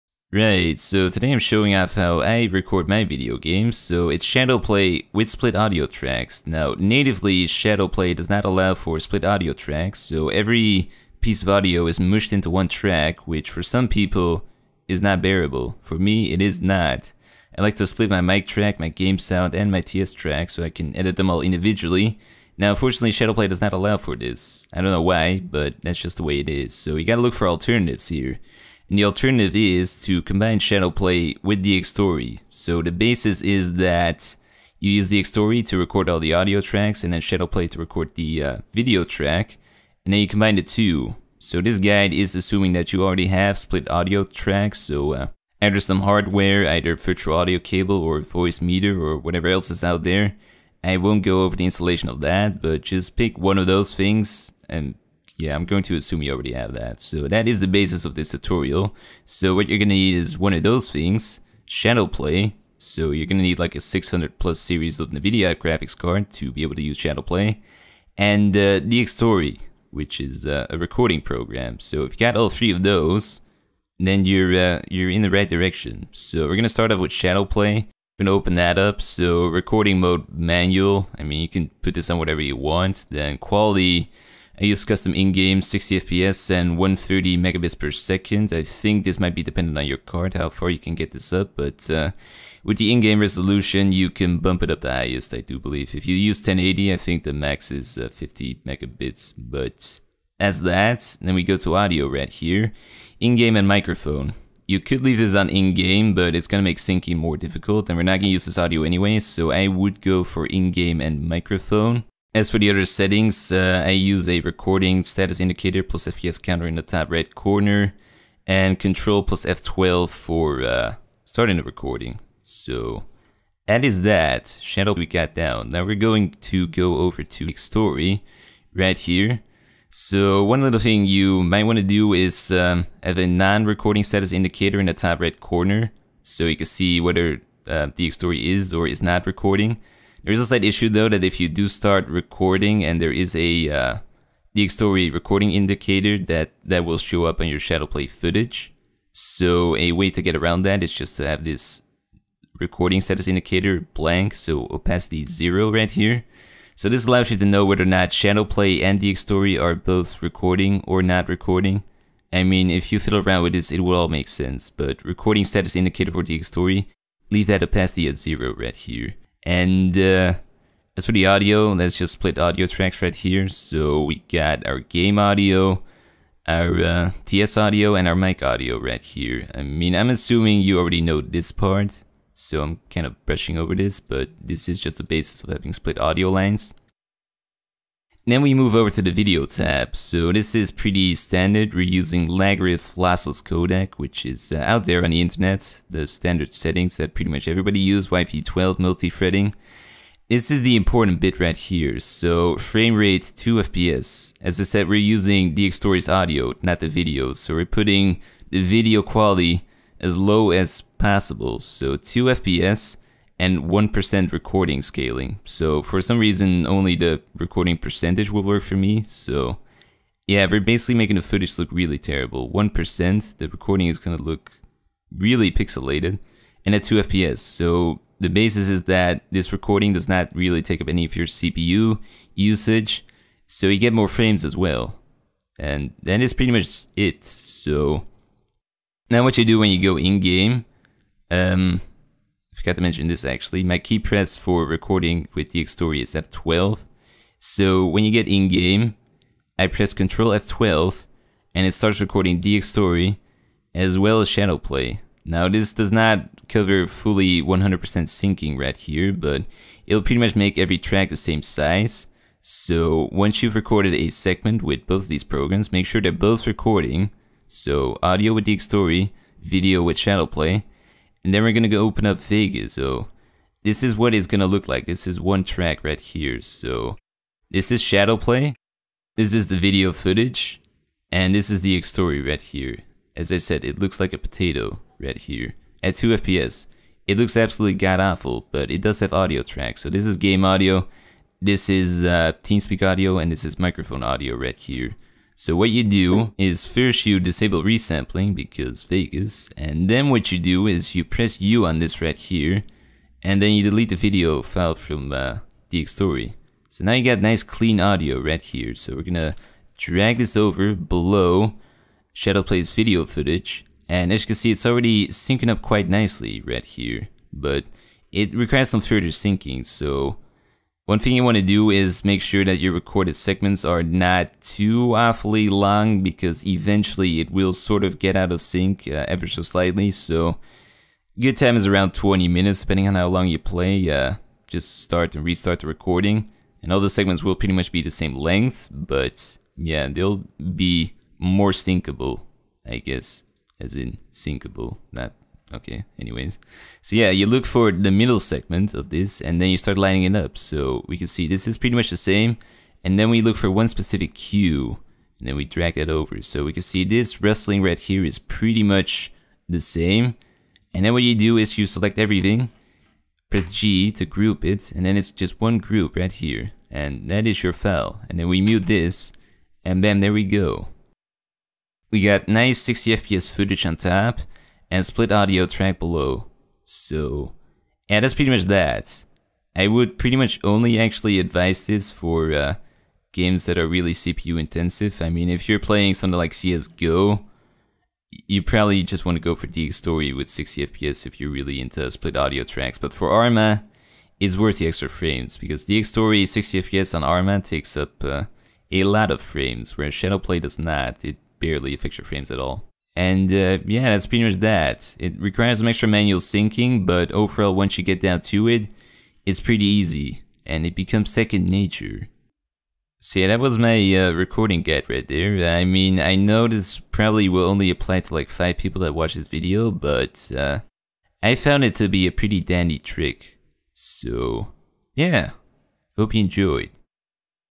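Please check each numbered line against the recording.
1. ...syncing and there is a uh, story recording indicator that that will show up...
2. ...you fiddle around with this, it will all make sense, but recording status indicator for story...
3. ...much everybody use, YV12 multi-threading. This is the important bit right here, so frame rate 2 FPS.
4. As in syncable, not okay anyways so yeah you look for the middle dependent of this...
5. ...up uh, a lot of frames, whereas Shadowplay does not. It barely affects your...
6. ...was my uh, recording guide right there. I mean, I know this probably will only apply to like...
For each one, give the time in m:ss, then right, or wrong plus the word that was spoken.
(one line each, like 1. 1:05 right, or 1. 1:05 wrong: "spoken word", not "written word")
1. 2:22 wrong: "recording", not "syncing"
2. 2:42 right
3. 3:17 right
4. 5:43 wrong: "segment", not "dependent"
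5. 6:37 right
6. 6:53 right.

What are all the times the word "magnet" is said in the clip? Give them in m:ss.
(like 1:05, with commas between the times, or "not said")
not said.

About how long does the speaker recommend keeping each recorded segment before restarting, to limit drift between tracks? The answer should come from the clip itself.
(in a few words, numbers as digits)
20 minutes.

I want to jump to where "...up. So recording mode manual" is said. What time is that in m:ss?
1:18.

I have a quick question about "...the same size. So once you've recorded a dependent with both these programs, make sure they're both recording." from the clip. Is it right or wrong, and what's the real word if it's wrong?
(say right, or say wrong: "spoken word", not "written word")
wrong: "segment", not "dependent".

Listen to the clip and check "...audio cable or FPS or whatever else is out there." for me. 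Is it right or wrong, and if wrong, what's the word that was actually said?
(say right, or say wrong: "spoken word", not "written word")
wrong: "VoiceMeeter", not "FPS".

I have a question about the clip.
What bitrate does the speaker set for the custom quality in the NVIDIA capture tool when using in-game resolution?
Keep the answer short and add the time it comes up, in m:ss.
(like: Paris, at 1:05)
130 megabits per second, at 1:26.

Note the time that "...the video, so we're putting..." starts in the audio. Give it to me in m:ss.
3:26.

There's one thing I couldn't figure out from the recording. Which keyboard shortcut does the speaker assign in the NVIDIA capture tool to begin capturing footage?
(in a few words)
Ctrl+F12.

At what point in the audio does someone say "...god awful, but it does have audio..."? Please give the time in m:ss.
4:47.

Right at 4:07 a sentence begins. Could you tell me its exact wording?
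So when you get in game, I press Ctrl F12 and it starts recording Dxtory as well as Shadowplay.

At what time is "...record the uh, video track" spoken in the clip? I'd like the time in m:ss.
0:37.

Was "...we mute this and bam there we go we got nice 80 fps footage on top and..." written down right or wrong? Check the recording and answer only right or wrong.
wrong.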